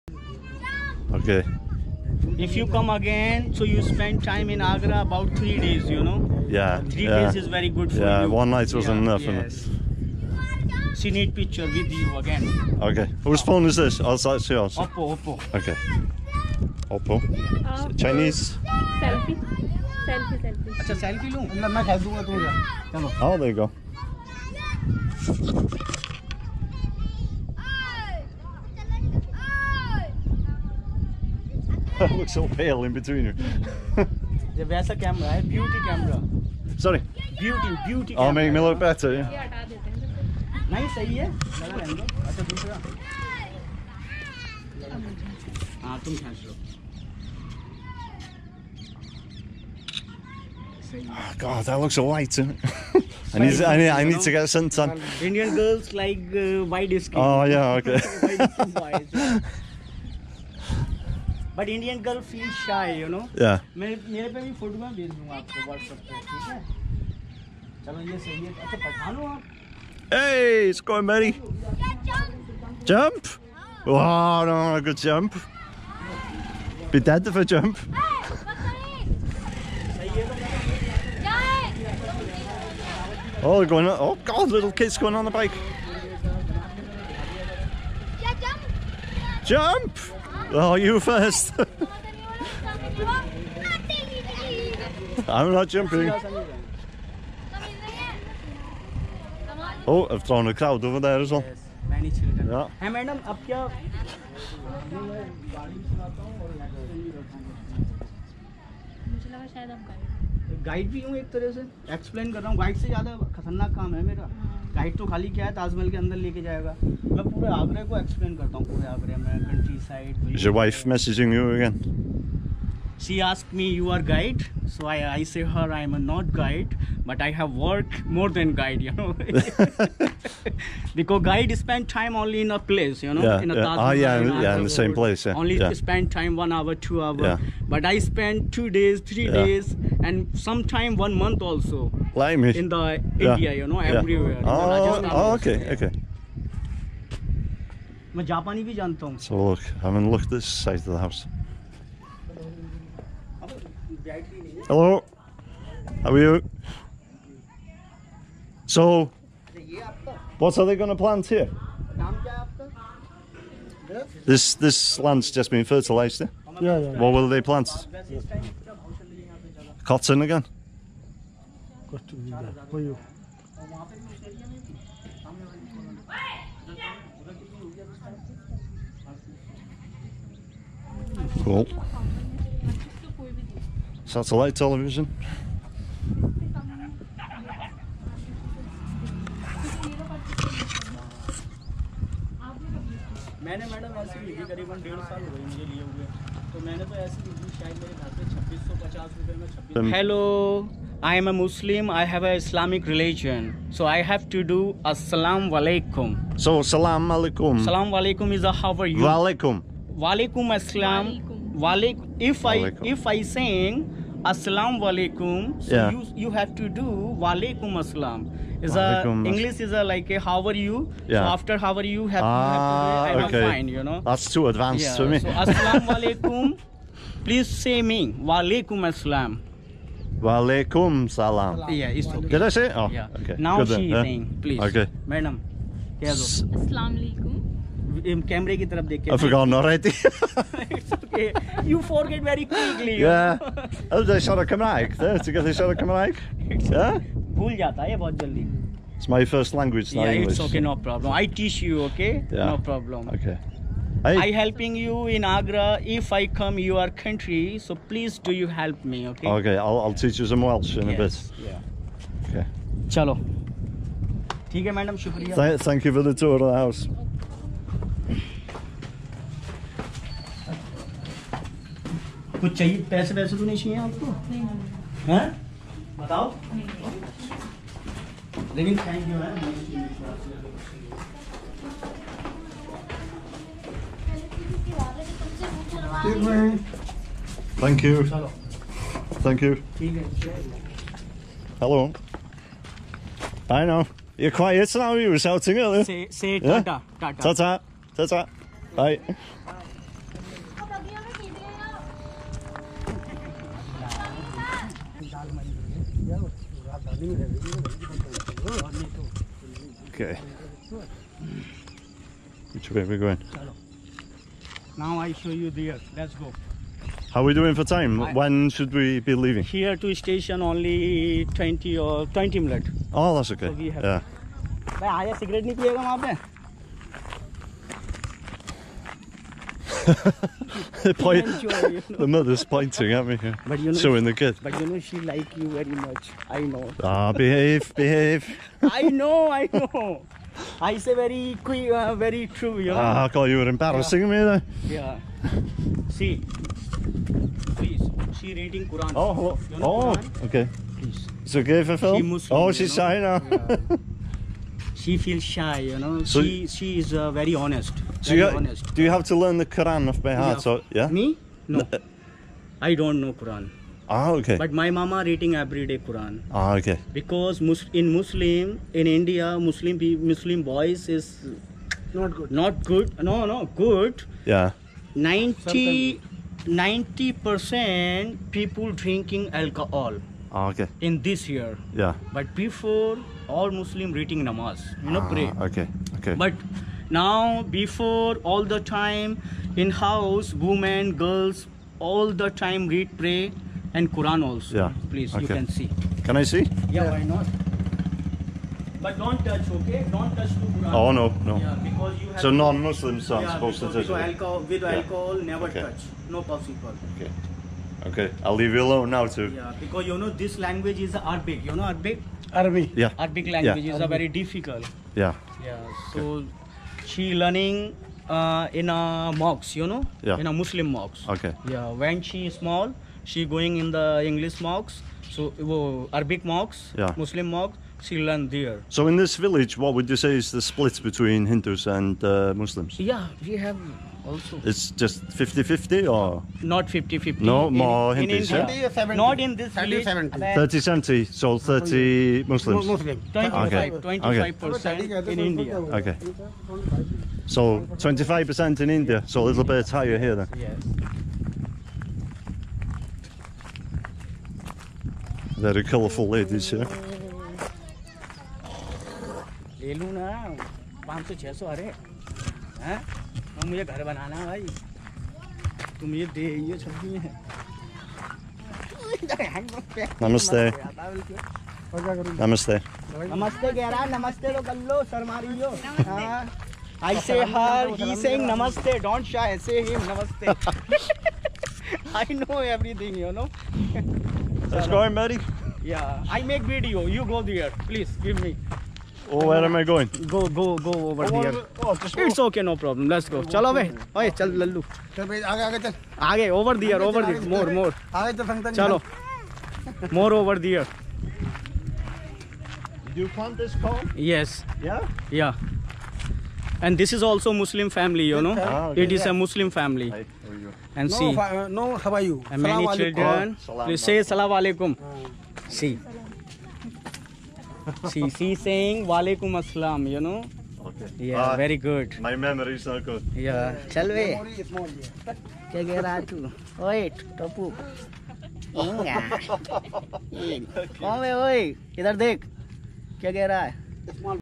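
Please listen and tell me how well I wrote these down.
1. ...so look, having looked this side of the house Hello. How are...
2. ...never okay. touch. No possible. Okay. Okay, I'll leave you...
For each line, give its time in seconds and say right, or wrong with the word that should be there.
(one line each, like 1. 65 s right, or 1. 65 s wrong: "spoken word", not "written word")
1. 149 s right
2. 405 s right.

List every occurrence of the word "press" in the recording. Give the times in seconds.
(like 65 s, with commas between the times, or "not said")
not said.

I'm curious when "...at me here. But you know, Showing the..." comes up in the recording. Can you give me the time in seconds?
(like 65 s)
332 s.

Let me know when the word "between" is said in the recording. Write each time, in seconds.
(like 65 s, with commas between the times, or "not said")
32 s, 430 s.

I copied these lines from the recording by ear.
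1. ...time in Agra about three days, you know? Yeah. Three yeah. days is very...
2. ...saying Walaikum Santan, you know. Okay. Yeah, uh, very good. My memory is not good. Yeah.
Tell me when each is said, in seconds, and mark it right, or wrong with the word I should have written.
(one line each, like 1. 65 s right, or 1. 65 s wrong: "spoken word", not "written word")
1. 4 s right
2. 518 s wrong: "Assalam", not "Santan".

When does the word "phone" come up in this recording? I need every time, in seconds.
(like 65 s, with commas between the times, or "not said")
13 s.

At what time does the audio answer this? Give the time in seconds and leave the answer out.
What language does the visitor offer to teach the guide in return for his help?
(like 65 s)
260 s.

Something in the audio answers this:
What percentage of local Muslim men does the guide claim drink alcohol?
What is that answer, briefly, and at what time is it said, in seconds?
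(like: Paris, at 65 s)
90 percent, at 374 s.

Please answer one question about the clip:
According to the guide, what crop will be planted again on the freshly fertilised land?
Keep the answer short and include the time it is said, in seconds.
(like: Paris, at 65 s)
Cotton, at 169 s.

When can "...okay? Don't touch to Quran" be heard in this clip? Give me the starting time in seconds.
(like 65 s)
399 s.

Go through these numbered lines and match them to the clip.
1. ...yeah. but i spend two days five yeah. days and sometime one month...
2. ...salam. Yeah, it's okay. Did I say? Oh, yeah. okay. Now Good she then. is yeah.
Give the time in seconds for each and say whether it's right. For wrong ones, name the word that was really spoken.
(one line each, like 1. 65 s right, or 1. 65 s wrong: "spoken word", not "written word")
1. 137 s wrong: "three", not "five"
2. 231 s right.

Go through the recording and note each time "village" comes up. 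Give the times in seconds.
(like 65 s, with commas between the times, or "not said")
429 s, 439 s.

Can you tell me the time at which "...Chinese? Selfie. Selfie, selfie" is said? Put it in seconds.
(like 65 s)
17 s.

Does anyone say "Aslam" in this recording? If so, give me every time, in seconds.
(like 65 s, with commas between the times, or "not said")
210 s.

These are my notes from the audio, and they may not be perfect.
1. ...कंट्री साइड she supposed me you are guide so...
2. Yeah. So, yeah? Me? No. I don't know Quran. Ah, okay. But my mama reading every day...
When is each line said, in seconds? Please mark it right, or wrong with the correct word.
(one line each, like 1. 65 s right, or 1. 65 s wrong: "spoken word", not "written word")
1. 119 s wrong: "asked", not "supposed"
2. 360 s right.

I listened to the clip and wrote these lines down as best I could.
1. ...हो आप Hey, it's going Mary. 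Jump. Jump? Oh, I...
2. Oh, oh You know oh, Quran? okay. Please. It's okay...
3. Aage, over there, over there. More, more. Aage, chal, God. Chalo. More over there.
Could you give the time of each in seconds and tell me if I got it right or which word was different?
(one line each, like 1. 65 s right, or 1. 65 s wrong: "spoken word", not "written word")
1. 69 s right
2. 348 s right
3. 496 s wrong: "Santan", not "God".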